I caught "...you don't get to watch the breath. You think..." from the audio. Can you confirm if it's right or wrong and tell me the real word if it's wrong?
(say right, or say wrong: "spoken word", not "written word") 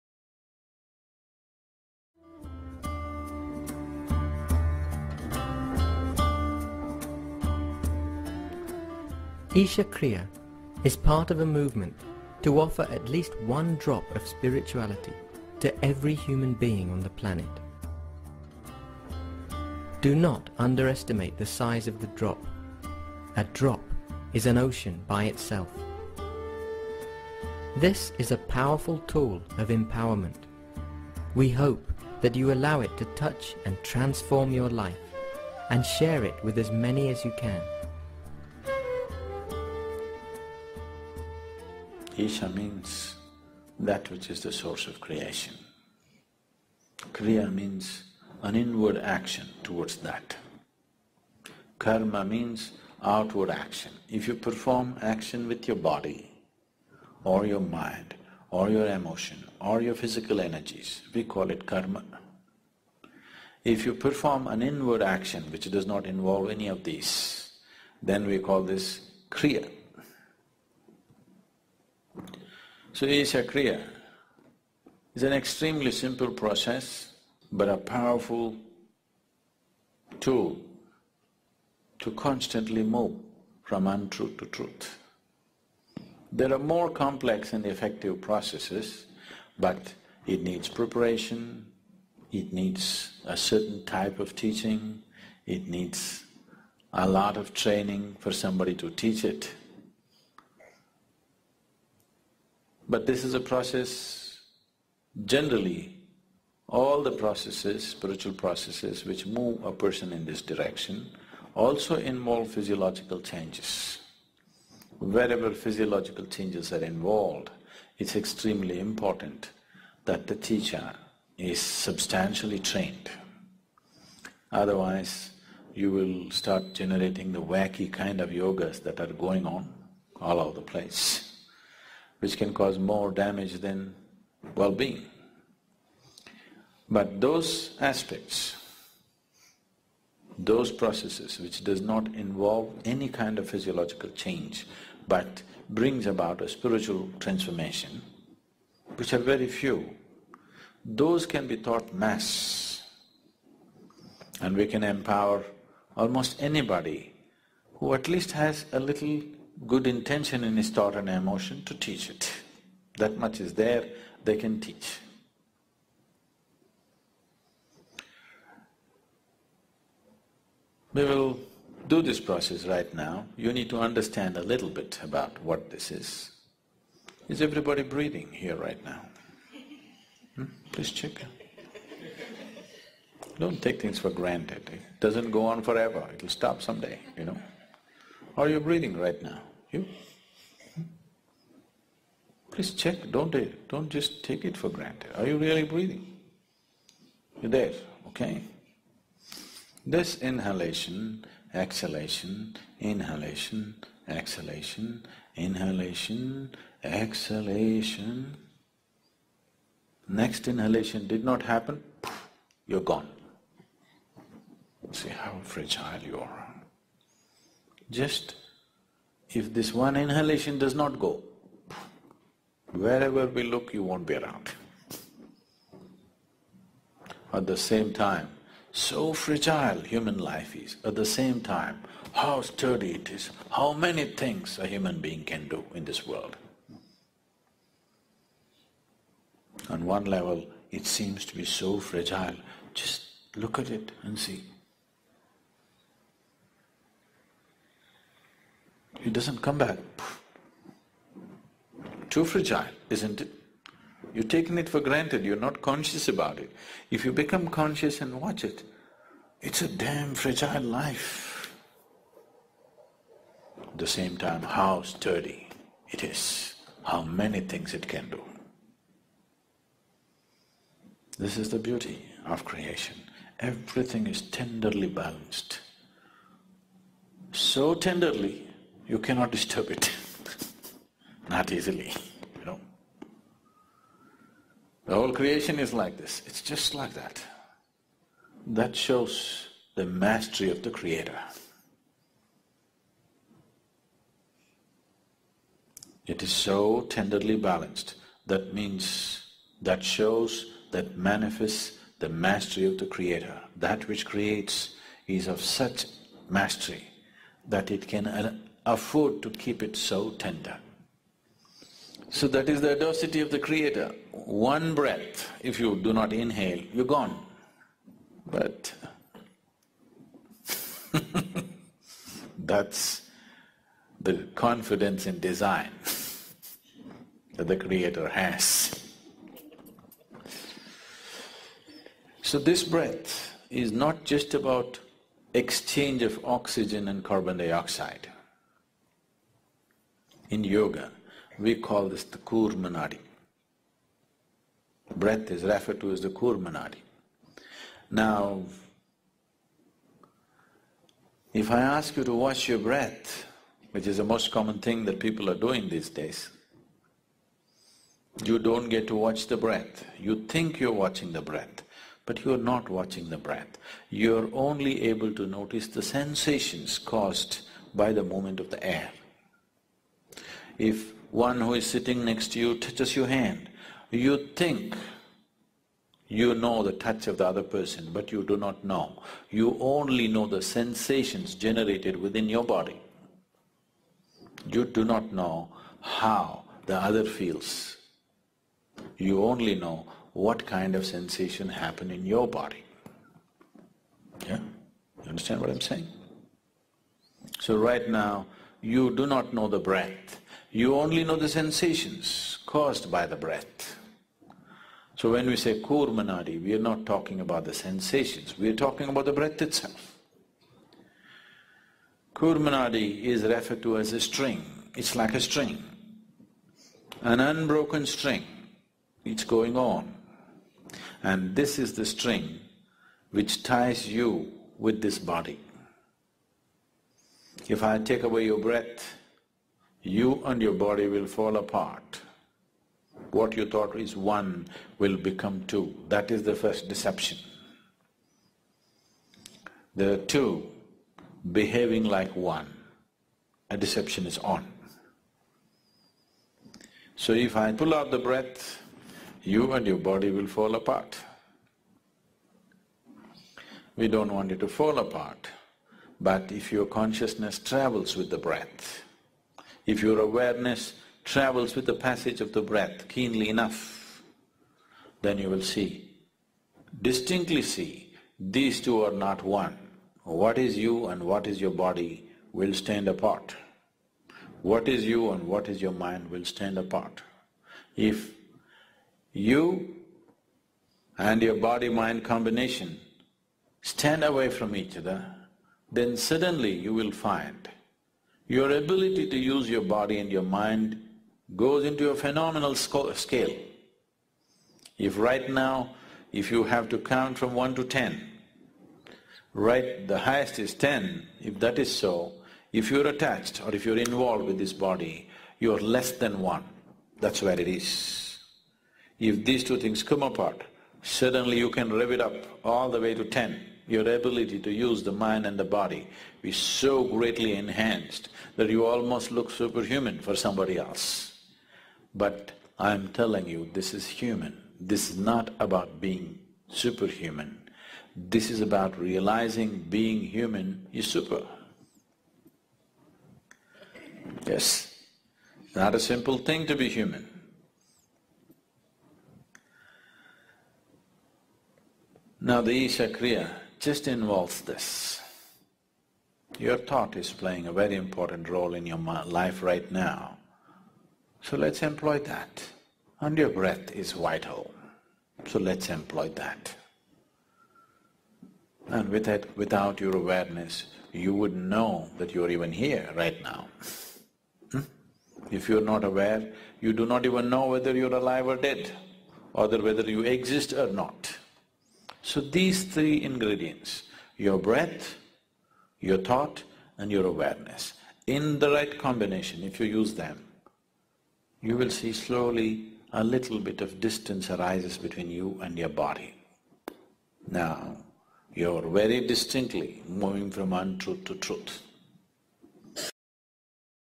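right.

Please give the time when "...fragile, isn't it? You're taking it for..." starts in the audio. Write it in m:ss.
4:12.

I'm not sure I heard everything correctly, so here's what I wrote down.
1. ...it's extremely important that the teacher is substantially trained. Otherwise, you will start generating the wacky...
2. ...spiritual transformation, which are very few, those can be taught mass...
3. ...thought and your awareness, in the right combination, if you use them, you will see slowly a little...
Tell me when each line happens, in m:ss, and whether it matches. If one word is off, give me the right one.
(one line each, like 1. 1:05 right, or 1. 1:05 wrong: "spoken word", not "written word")
1. 1:57 right
2. 2:26 right
3. 9:35 right.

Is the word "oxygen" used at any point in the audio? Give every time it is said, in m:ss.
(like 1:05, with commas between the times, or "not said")
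5:36.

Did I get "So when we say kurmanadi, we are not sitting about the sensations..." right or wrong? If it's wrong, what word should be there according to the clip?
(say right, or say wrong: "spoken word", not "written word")
wrong: "talking", not "sitting".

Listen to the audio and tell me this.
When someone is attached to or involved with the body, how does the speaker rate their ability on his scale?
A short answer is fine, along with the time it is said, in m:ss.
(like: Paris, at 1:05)
less than 1, at 8:25.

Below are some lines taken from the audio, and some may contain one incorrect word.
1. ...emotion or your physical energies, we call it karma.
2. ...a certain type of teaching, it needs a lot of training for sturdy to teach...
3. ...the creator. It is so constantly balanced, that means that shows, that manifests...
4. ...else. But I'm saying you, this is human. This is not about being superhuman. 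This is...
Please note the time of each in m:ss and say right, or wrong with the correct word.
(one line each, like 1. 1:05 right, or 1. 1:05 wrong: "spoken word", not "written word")
1. 0:58 right
2. 1:33 wrong: "somebody", not "sturdy"
3. 4:50 wrong: "tenderly", not "constantly"
4. 8:40 wrong: "telling", not "saying".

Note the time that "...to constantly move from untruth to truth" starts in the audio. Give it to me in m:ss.
1:21.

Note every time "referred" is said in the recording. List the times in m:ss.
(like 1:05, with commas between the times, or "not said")
5:45, 6:53.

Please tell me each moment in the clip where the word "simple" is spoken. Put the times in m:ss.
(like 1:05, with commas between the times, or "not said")
1:15, 8:55.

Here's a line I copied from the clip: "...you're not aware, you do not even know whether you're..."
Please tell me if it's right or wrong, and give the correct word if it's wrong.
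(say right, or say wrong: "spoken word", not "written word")
right.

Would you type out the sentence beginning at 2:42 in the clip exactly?
That much is there, they can teach.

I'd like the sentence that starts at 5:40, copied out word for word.
In yoga, we call this the Kurmanadi.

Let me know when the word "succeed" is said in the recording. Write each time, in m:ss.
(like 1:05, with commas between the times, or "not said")
not said.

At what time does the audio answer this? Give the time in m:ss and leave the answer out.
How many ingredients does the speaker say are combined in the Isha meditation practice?
9:32.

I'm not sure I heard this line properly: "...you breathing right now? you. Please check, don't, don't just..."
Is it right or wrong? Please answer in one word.
right.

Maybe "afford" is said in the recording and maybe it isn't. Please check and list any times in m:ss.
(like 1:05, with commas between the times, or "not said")
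5:08.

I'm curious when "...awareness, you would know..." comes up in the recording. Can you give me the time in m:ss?
9:19.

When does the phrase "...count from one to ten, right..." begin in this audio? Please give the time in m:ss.
8:16.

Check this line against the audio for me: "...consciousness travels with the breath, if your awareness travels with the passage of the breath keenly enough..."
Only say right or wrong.
right.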